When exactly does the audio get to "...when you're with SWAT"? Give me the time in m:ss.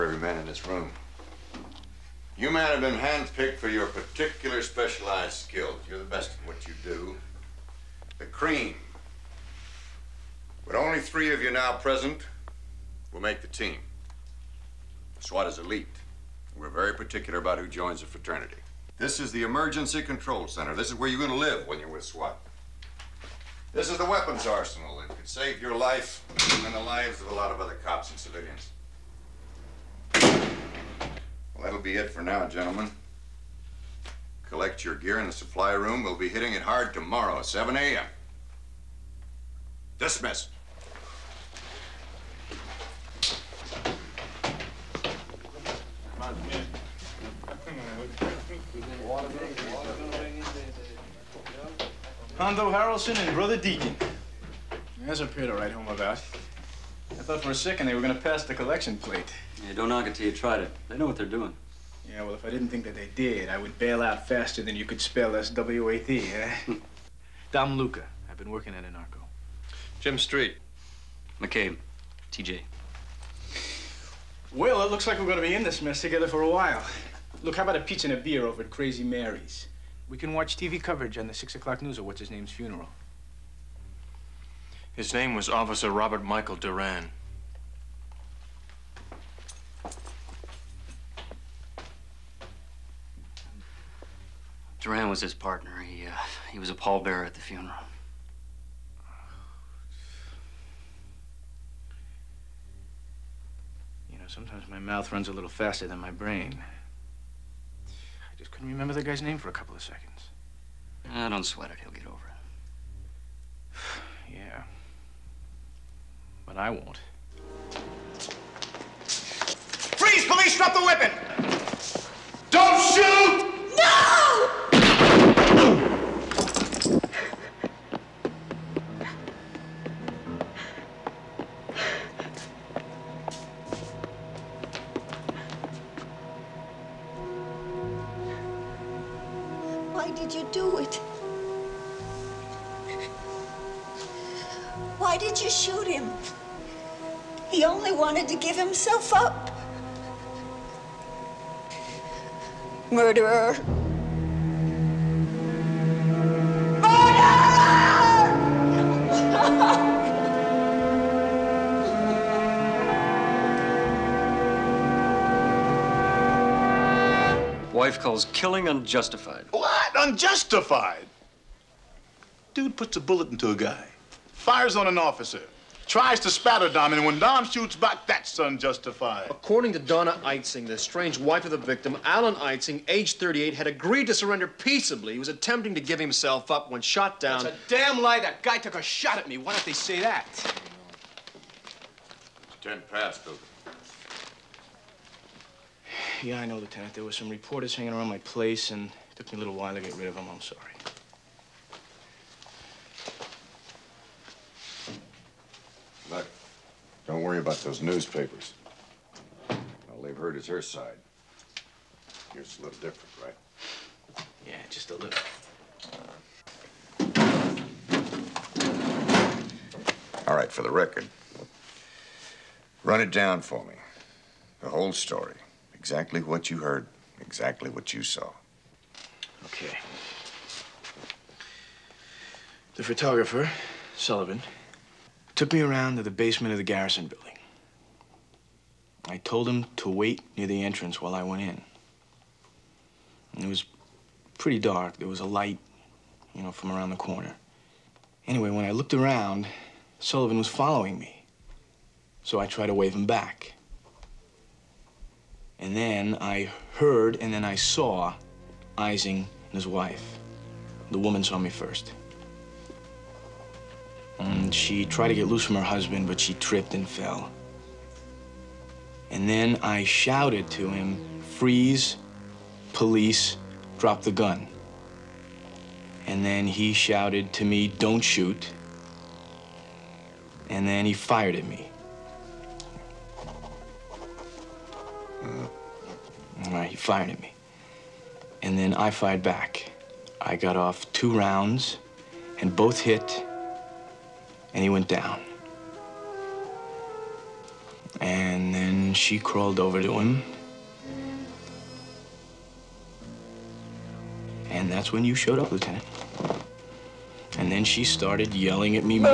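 0:21.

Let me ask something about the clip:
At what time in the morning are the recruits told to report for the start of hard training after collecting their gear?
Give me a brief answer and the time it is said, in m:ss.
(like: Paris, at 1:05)
7 a.m., at 0:37.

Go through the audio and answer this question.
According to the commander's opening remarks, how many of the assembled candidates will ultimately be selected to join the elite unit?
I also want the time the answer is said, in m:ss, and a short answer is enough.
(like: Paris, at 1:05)
3, at 0:10.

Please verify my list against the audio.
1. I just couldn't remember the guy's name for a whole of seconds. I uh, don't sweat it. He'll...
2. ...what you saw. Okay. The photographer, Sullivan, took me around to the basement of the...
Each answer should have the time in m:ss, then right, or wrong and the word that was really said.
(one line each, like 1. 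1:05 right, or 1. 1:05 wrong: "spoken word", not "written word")
1. 1:47 wrong: "couple", not "whole"
2. 3:47 right.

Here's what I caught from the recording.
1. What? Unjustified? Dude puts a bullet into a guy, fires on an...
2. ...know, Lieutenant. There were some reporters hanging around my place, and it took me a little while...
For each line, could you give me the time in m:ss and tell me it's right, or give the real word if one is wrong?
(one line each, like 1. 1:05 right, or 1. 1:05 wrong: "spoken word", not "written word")
1. 2:49 right
2. 3:16 right.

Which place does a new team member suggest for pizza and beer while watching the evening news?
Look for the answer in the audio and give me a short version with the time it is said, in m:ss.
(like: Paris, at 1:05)
Crazy Mary's, at 1:18.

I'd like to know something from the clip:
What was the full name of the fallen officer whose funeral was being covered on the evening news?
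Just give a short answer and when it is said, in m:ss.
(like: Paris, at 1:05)
Robert Michael Duran, at 1:25.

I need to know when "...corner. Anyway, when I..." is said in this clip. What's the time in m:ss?
4:06.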